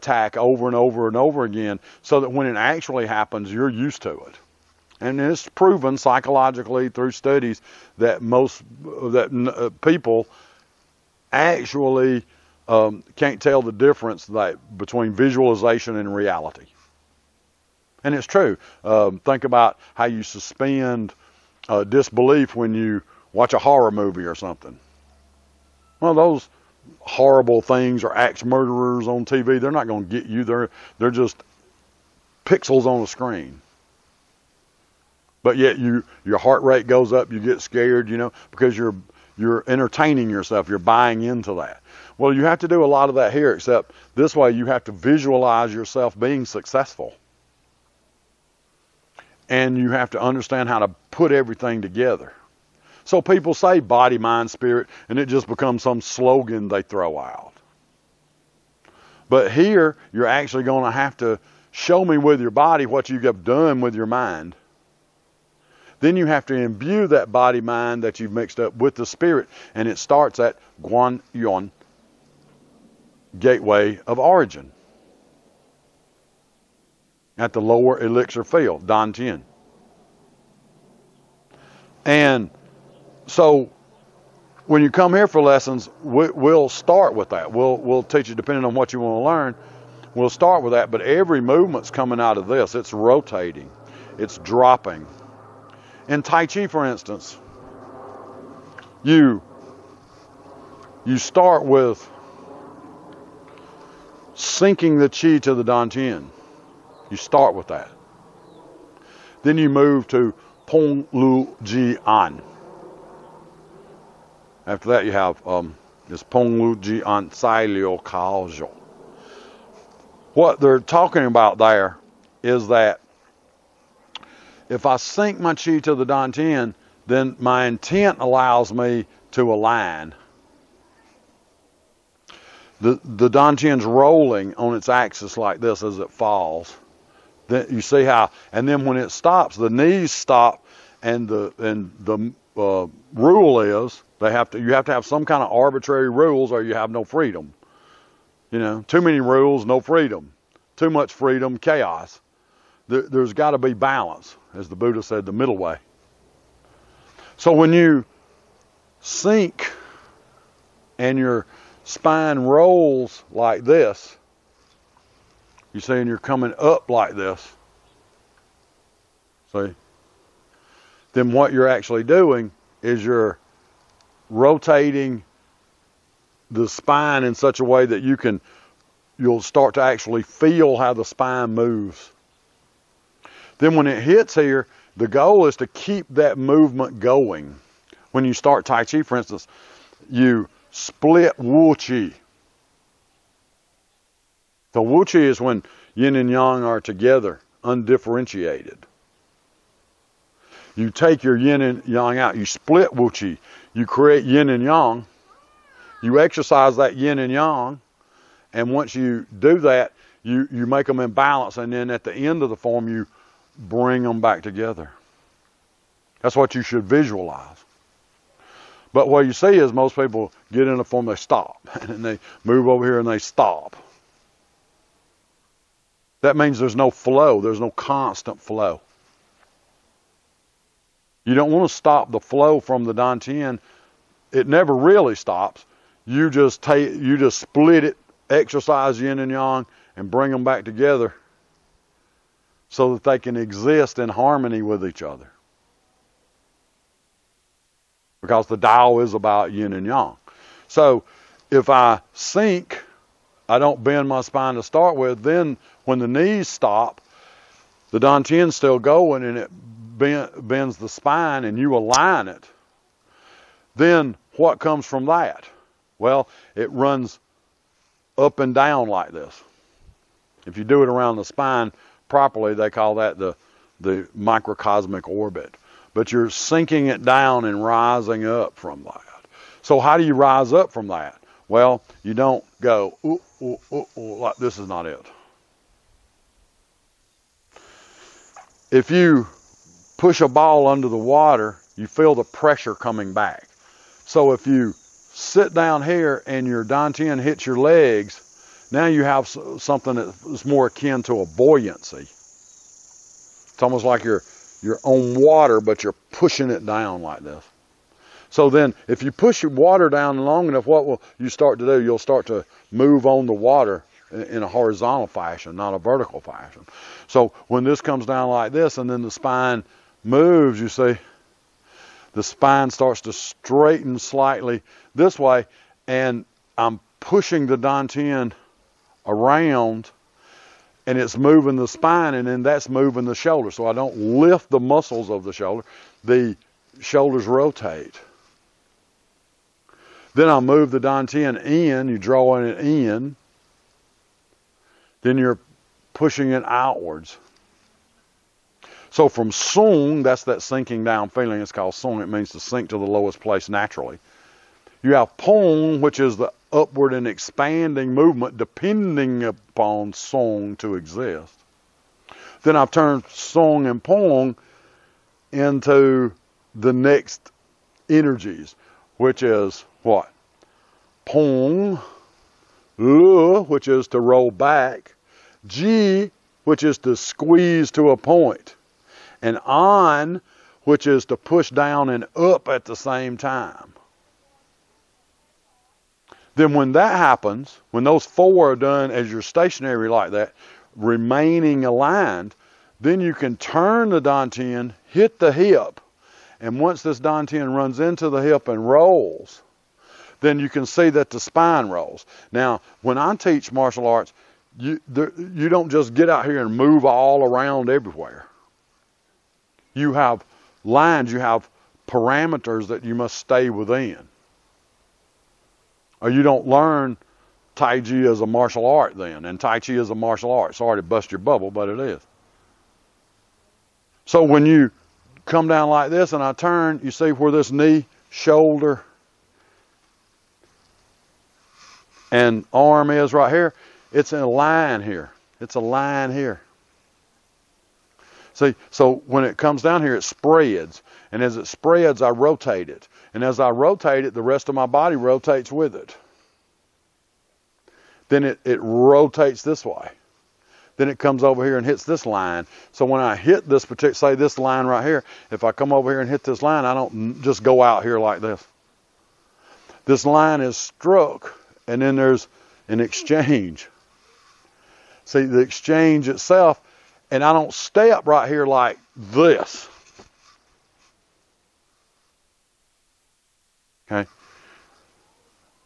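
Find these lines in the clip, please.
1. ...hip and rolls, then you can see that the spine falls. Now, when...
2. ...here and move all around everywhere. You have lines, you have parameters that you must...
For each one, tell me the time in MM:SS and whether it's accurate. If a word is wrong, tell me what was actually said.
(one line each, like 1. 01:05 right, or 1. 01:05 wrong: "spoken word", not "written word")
1. 06:38 wrong: "rolls", not "falls"
2. 06:46 right.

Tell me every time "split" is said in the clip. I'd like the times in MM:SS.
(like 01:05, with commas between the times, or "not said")
03:10, 03:22, 03:57.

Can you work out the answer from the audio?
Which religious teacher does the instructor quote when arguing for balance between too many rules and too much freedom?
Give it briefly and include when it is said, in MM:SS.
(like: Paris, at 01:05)
the Buddha, at 02:34.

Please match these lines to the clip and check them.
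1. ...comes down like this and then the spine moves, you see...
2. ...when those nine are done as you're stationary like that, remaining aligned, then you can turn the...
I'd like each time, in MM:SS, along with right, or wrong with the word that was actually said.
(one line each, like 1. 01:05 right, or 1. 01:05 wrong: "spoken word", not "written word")
1. 05:17 right
2. 06:27 wrong: "four", not "nine".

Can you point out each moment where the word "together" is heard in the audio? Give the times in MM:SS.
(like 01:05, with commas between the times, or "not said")
00:51, 03:16, 03:34, 04:00.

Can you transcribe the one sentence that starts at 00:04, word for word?
And it's proven psychologically through studies that most that uh, people actually um, can't tell the difference that, between visualization and reality.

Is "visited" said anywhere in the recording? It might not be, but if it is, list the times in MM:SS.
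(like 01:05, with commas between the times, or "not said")
not said.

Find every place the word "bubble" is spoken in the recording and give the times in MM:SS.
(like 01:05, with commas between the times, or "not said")
07:01.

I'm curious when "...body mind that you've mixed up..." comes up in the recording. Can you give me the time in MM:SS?
01:07.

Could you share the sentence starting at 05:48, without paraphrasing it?
So from sung, that's that sinking down feeling.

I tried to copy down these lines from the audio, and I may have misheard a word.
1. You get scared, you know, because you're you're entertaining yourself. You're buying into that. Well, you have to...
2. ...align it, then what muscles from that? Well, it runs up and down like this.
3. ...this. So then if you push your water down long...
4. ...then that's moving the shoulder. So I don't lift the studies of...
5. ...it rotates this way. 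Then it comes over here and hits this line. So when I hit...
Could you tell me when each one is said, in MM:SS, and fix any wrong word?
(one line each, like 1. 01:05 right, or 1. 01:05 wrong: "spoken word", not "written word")
1. 00:37 right
2. 04:21 wrong: "comes", not "muscles"
3. 05:07 right
4. 05:32 wrong: "muscles", not "studies"
5. 07:28 right.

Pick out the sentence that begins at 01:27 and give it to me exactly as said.
We'll we'll teach you depending on what you want to learn.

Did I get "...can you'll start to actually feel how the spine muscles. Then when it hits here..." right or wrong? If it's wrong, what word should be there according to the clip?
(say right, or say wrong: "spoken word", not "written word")
wrong: "moves", not "muscles".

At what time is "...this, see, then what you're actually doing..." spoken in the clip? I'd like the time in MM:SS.
02:47.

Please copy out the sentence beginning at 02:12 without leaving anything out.
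The, the Dantian's rolling on its axis like this as it falls.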